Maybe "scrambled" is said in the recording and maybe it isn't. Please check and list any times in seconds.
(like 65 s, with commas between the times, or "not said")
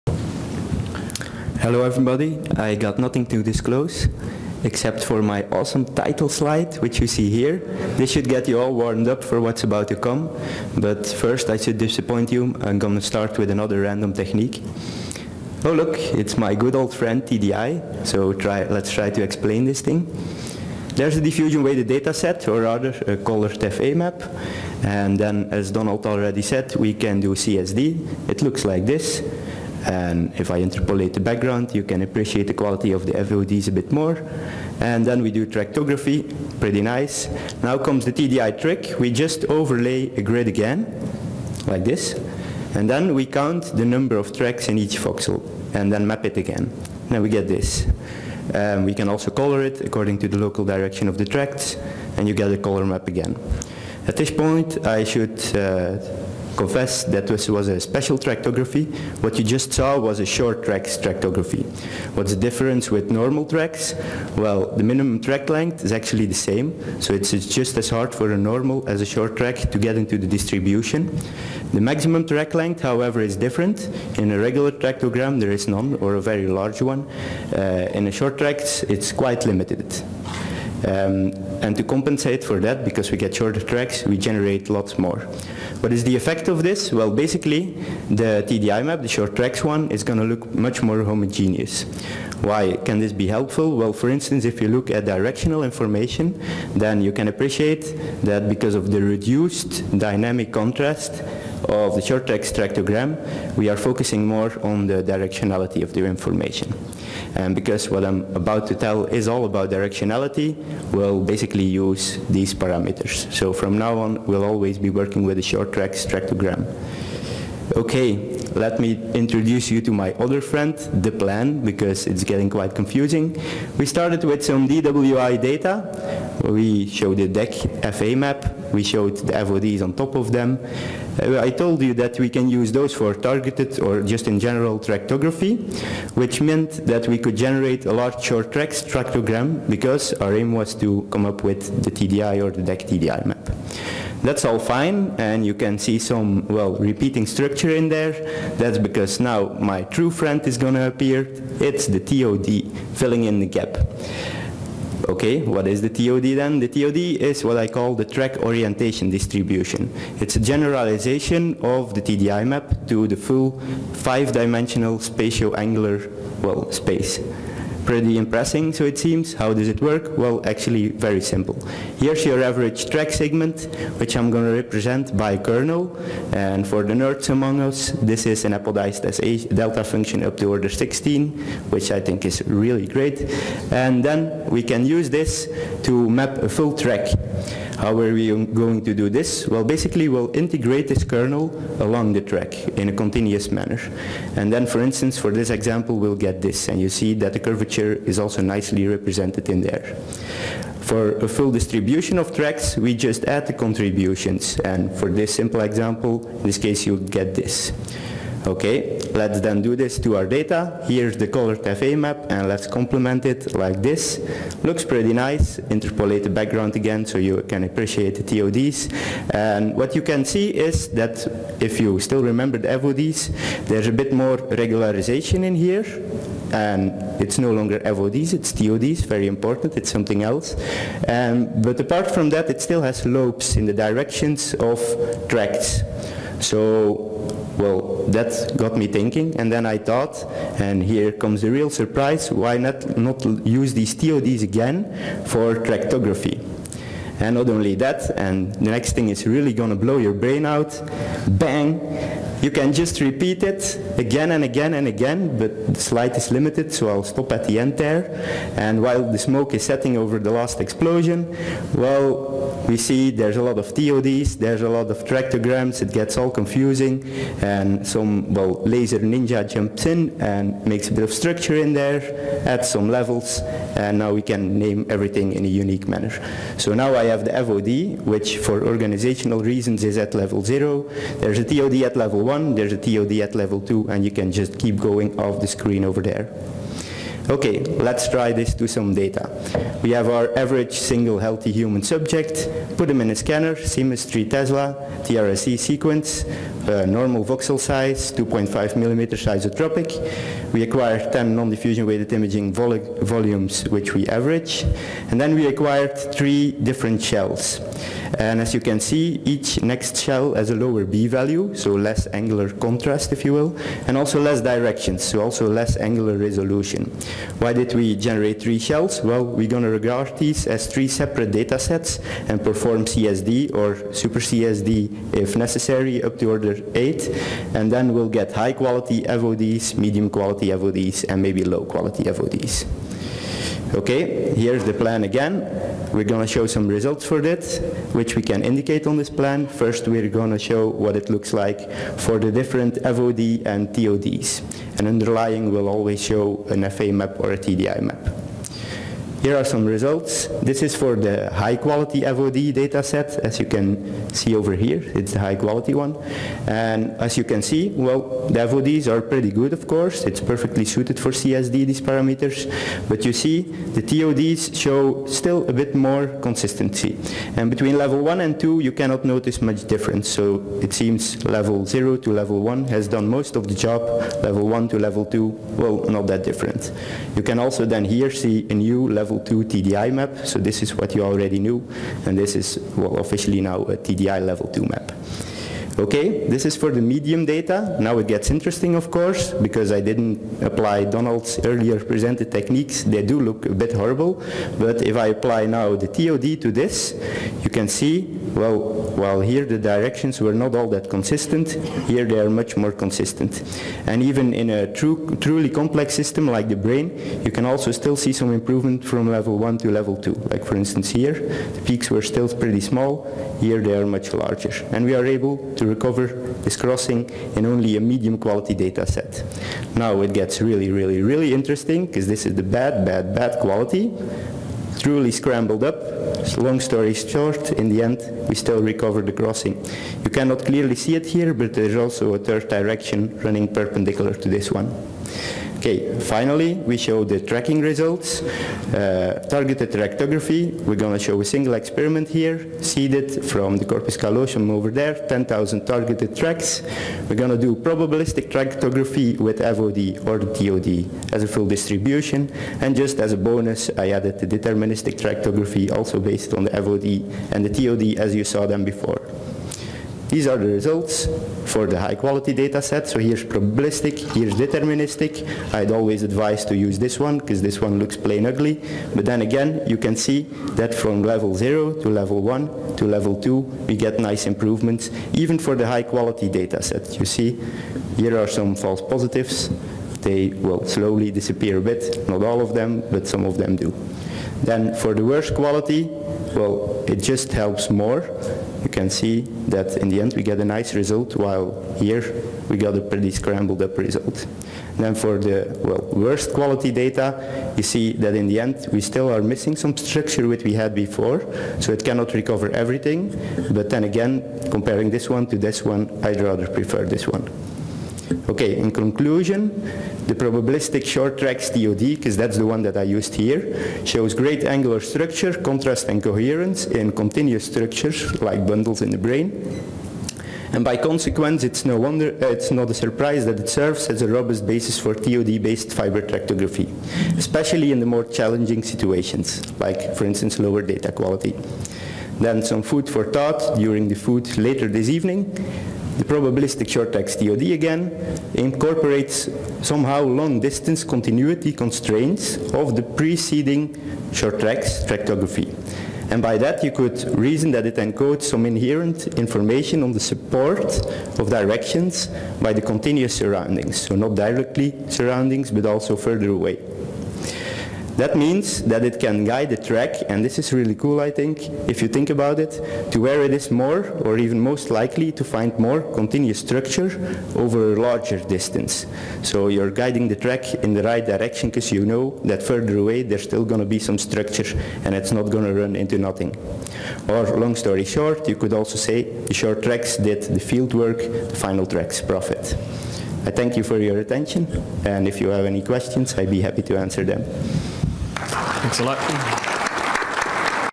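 425 s, 493 s.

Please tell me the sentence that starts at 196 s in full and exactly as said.
And you see that the curvature is also nicely represented in there.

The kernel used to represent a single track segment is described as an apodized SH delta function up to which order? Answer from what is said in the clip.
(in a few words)
16.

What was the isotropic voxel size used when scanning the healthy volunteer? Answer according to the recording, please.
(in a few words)
2.5 millimeter.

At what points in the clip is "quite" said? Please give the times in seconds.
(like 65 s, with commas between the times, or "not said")
79 s, 122 s.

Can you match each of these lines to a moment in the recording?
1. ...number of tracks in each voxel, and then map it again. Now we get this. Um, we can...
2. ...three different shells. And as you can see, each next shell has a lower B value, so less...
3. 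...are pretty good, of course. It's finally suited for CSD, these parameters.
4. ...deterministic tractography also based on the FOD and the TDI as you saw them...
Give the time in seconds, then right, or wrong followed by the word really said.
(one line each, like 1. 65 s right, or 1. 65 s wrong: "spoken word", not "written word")
1. 43 s right
2. 305 s right
3. 358 s wrong: "perfectly", not "finally"
4. 454 s wrong: "TOD", not "TDI".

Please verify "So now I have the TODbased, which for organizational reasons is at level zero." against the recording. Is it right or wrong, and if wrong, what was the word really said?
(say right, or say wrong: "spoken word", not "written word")
wrong: "FOD", not "TODbased".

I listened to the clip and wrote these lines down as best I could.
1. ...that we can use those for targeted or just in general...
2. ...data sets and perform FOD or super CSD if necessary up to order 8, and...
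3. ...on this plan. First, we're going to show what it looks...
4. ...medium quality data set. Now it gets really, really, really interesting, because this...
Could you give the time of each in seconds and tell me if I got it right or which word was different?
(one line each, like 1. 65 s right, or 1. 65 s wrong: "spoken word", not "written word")
1. 131 s right
2. 321 s wrong: "CSD", not "FOD"
3. 338 s right
4. 417 s right.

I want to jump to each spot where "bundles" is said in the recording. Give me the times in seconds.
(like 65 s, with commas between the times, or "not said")
518 s.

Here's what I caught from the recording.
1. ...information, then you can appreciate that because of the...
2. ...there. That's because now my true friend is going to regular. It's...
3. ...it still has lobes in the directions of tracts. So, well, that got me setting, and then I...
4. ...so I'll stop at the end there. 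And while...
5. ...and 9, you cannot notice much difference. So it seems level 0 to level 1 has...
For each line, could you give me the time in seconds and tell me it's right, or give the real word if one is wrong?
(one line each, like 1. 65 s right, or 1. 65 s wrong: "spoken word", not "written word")
1. 95 s right
2. 147 s wrong: "appear", not "regular"
3. 232 s wrong: "thinking", not "setting"
4. 256 s right
5. 368 s wrong: "2", not "9".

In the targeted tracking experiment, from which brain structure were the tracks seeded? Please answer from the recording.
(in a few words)
corpus callosum.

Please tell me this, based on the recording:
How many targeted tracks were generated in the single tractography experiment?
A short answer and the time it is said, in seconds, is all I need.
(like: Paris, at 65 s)
10,000, at 445 s.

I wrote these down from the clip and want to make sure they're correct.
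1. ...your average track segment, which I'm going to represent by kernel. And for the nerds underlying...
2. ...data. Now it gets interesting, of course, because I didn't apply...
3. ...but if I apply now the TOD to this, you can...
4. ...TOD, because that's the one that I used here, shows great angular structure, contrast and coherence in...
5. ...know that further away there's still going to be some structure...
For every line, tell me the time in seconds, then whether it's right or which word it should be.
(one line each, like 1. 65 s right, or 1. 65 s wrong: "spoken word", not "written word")
1. 172 s wrong: "among", not "underlying"
2. 387 s right
3. 394 s right
4. 511 s right
5. 571 s right.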